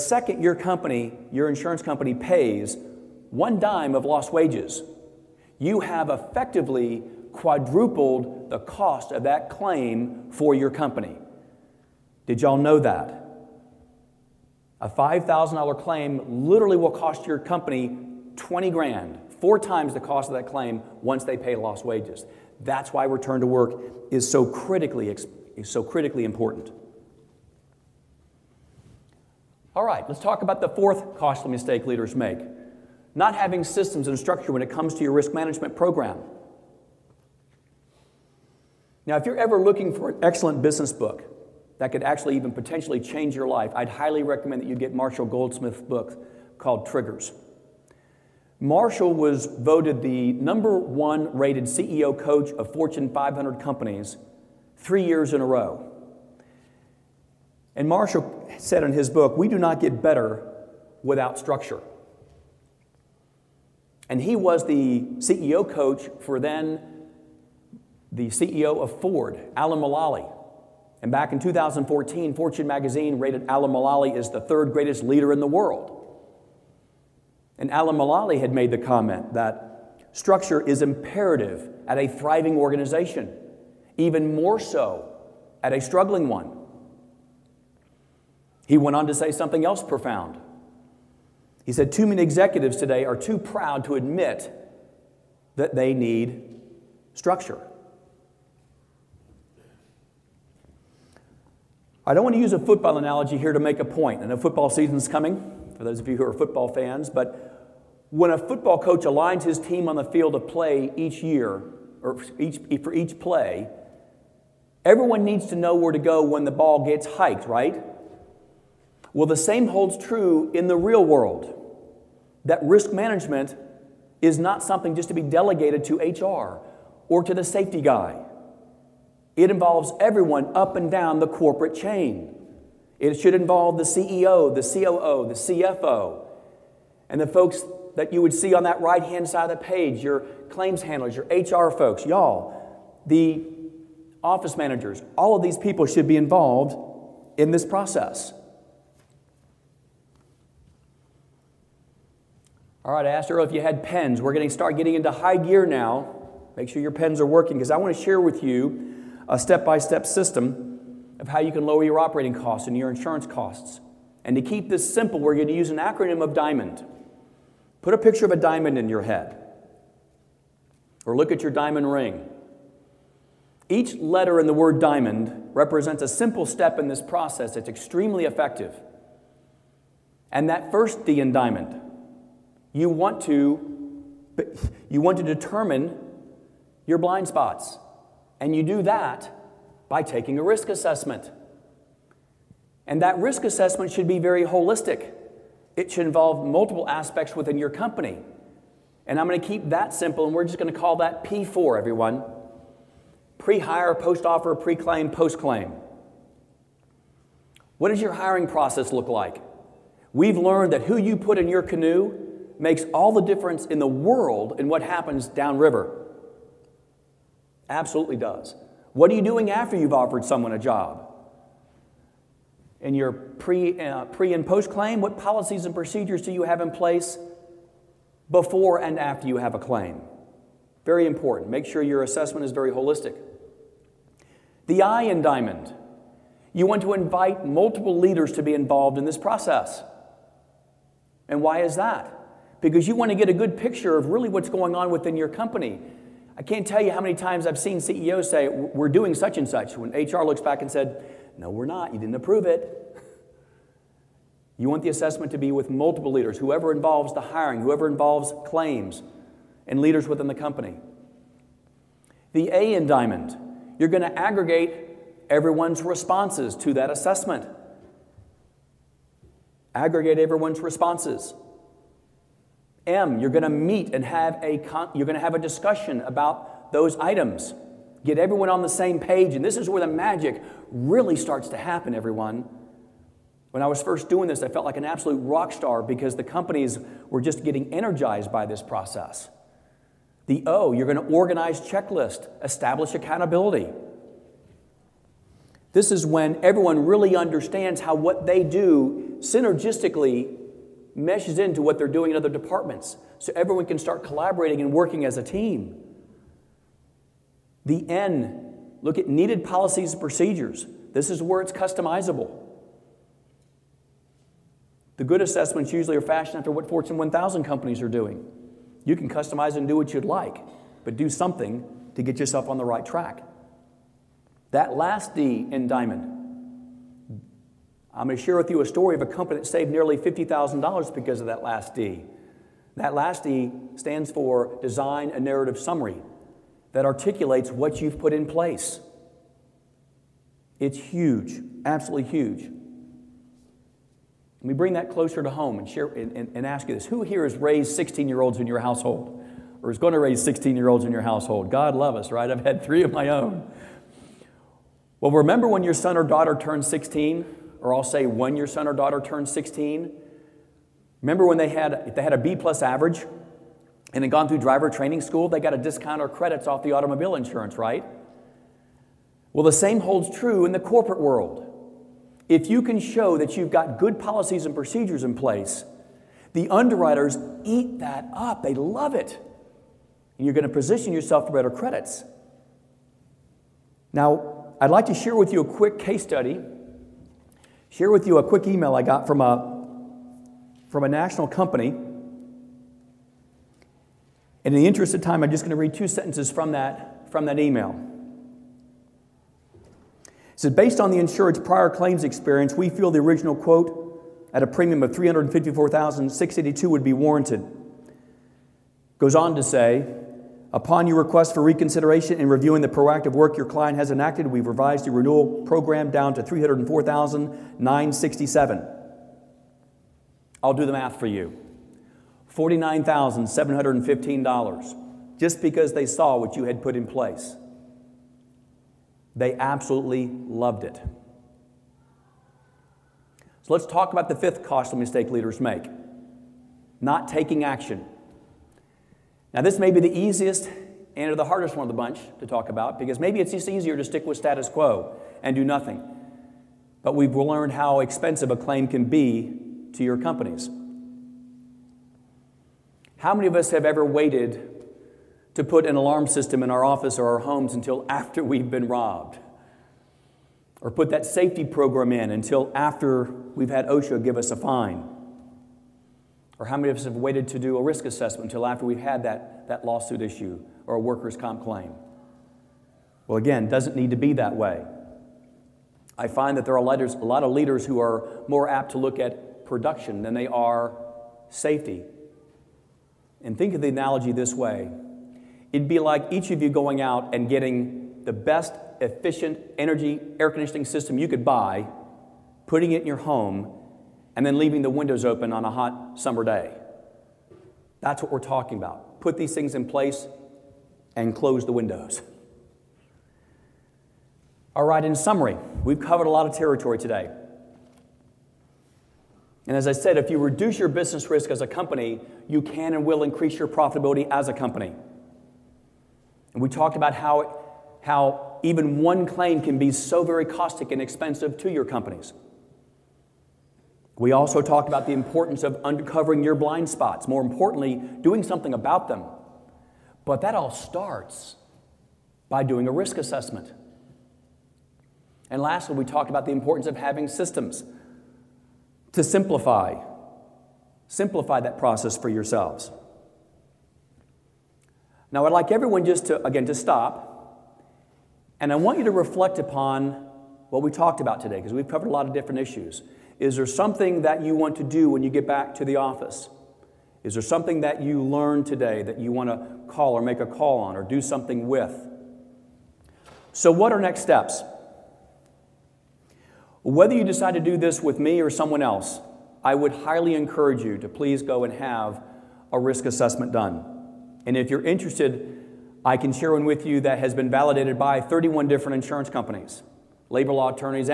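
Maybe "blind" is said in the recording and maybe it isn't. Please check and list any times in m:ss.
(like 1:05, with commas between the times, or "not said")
3:06, 8:46.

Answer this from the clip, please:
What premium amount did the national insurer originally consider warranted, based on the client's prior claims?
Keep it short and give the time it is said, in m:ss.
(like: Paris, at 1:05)
354,682, at 6:44.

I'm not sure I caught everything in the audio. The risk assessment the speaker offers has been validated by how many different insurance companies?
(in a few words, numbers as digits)
31.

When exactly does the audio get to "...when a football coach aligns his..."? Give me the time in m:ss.
1:48.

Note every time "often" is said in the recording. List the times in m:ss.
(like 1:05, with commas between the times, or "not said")
not said.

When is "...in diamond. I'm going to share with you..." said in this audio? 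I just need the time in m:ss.
5:25.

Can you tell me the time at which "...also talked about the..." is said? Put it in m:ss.
8:44.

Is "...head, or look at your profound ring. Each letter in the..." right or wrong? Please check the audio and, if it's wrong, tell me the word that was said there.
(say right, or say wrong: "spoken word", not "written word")
wrong: "diamond", not "profound".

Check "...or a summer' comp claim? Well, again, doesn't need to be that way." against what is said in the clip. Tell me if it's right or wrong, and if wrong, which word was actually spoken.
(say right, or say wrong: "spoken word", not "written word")
wrong: "workers", not "summer".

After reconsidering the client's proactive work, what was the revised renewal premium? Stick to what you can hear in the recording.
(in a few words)
304,967.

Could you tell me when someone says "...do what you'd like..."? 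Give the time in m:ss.
5:19.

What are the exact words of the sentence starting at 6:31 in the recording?
And in the interest of time, I'm just going to read two sentences from that, from that email.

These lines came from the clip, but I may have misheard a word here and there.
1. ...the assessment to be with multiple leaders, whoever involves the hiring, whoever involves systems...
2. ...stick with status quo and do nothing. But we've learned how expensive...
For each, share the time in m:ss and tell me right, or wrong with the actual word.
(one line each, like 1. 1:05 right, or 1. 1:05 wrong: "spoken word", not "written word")
1. 4:14 wrong: "claims", not "systems"
2. 7:23 right.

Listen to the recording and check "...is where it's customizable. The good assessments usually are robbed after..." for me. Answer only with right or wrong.
wrong.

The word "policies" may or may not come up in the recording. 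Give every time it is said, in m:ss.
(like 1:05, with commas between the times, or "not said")
3:45, 5:09, 6:13.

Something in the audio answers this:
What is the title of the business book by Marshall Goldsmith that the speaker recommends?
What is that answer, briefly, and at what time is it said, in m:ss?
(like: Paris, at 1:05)
Triggers, at 0:46.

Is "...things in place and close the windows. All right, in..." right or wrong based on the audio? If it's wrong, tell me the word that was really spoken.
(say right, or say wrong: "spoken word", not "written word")
right.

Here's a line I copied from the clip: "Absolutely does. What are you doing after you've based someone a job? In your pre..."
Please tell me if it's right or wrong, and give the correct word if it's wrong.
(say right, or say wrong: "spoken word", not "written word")
wrong: "offered", not "based".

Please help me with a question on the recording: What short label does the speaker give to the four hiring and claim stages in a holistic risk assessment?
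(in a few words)
P4.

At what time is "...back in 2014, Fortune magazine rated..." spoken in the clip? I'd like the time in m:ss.
1:11.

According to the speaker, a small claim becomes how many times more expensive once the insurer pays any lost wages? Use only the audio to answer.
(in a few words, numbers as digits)
4.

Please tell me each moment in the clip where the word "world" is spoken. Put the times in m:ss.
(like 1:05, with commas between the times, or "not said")
1:15, 2:01, 3:33, 6:11.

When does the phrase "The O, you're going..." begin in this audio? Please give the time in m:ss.
4:50.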